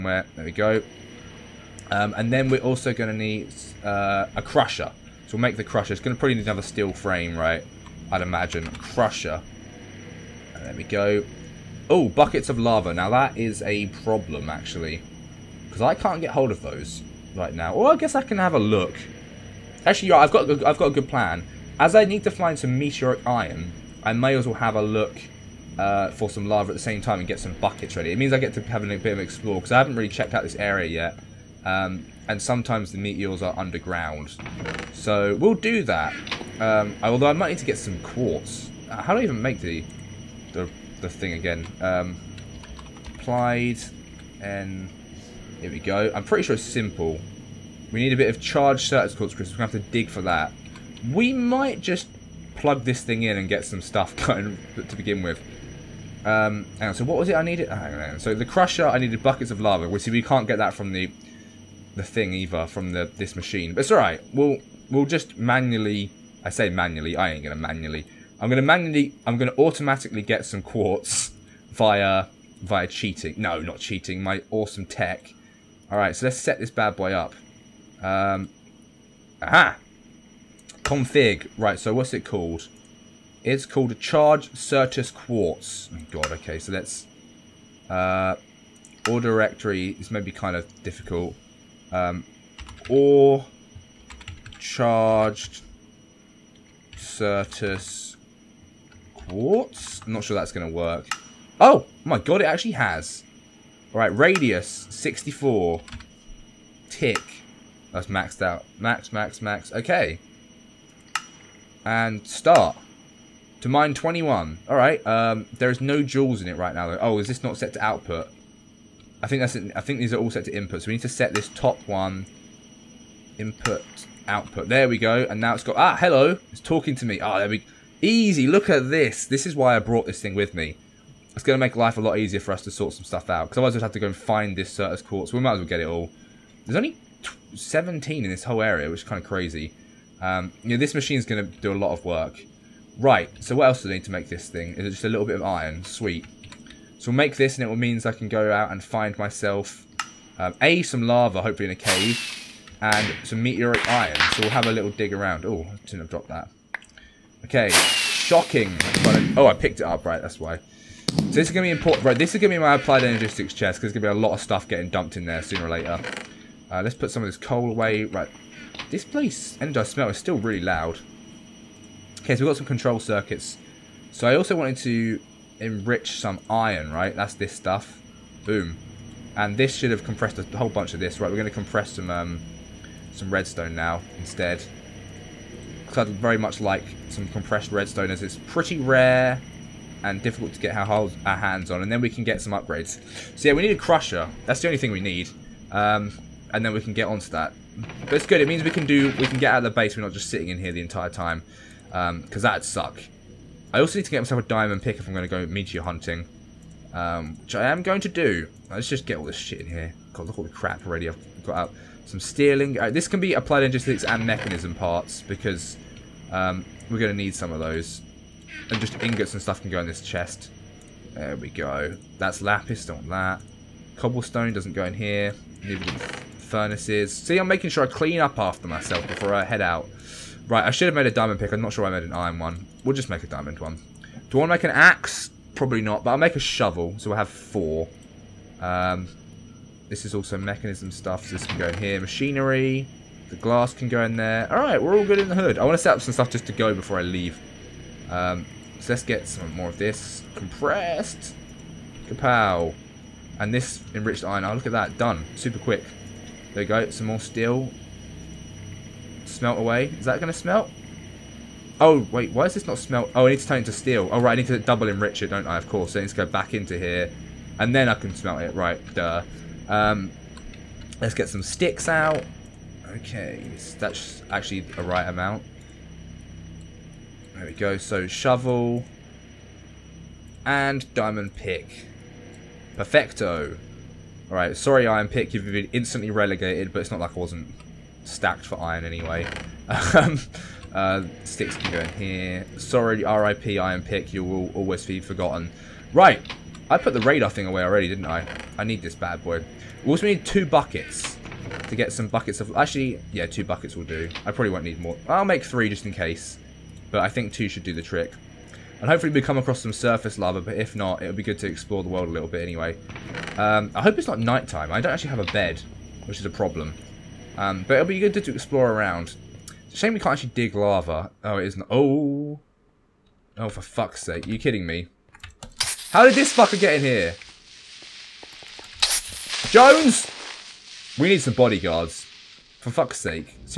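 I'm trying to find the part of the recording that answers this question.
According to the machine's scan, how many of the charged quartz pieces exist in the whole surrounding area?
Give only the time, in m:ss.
2:17.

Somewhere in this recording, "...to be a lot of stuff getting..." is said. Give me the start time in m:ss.
2:43.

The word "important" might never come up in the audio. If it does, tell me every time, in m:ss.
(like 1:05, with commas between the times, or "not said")
2:41.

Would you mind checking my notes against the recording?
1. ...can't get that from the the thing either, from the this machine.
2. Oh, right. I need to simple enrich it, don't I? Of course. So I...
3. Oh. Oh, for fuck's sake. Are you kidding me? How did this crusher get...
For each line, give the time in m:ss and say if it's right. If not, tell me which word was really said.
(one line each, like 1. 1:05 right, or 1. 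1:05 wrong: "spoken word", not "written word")
1. 1:00 right
2. 4:24 wrong: "double", not "simple"
3. 5:21 wrong: "fucker", not "crusher".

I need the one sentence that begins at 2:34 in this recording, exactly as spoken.
So we'll have a little dig around.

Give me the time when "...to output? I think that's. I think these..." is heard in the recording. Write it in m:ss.
1:57.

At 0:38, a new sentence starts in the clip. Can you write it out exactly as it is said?
Uh, how do I even make the the the thing again.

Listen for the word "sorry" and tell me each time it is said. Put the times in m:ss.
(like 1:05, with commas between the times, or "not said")
4:44, 4:52.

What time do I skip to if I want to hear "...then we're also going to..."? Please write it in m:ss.
0:02.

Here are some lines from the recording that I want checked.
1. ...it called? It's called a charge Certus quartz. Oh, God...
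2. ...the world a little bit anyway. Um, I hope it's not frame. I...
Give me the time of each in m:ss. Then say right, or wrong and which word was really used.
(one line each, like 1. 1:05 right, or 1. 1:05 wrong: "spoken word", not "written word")
1. 1:22 right
2. 5:11 wrong: "nighttime", not "frame".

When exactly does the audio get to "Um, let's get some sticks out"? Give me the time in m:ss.
4:29.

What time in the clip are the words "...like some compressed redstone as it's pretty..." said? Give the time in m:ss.
3:06.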